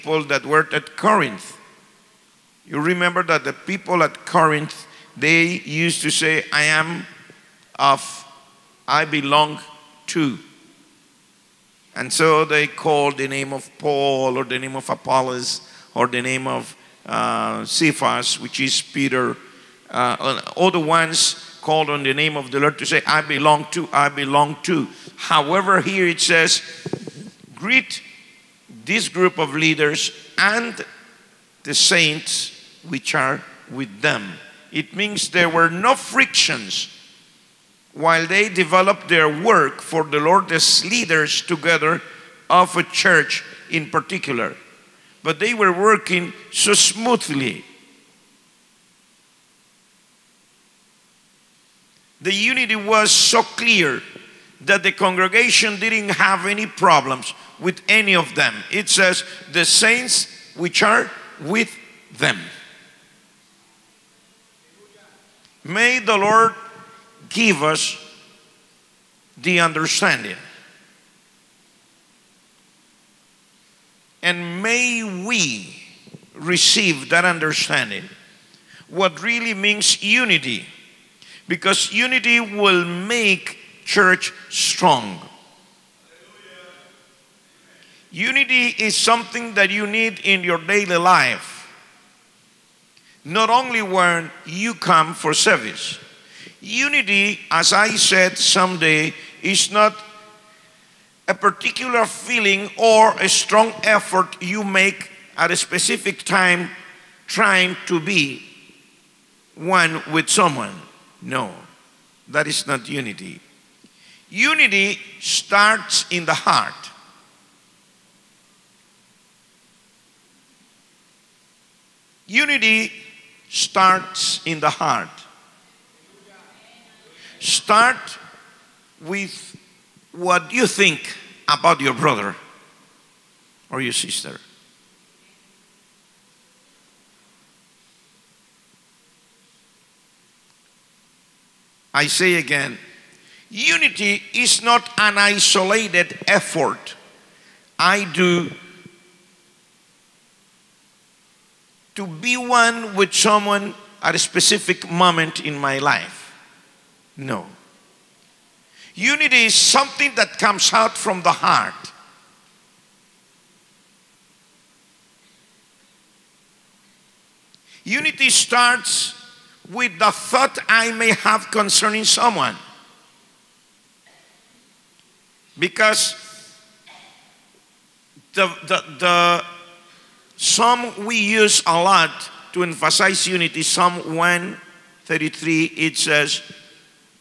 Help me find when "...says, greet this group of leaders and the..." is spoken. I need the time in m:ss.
0:26.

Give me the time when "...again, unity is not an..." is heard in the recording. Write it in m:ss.
2:22.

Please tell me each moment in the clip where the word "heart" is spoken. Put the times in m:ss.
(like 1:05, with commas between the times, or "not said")
1:56, 2:04, 2:41.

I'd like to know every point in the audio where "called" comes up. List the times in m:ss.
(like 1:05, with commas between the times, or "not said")
0:12, 0:21.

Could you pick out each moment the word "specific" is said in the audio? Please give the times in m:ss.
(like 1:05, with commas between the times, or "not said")
1:45, 2:34.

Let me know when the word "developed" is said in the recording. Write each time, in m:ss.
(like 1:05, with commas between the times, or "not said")
0:38.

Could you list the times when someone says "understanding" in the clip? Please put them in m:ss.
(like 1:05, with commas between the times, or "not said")
1:09, 1:17.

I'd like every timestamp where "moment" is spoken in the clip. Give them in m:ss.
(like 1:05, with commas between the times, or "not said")
2:34.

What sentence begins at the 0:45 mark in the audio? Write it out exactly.
But they were working so smoothly.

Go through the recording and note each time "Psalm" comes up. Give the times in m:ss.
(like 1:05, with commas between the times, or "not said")
3:03.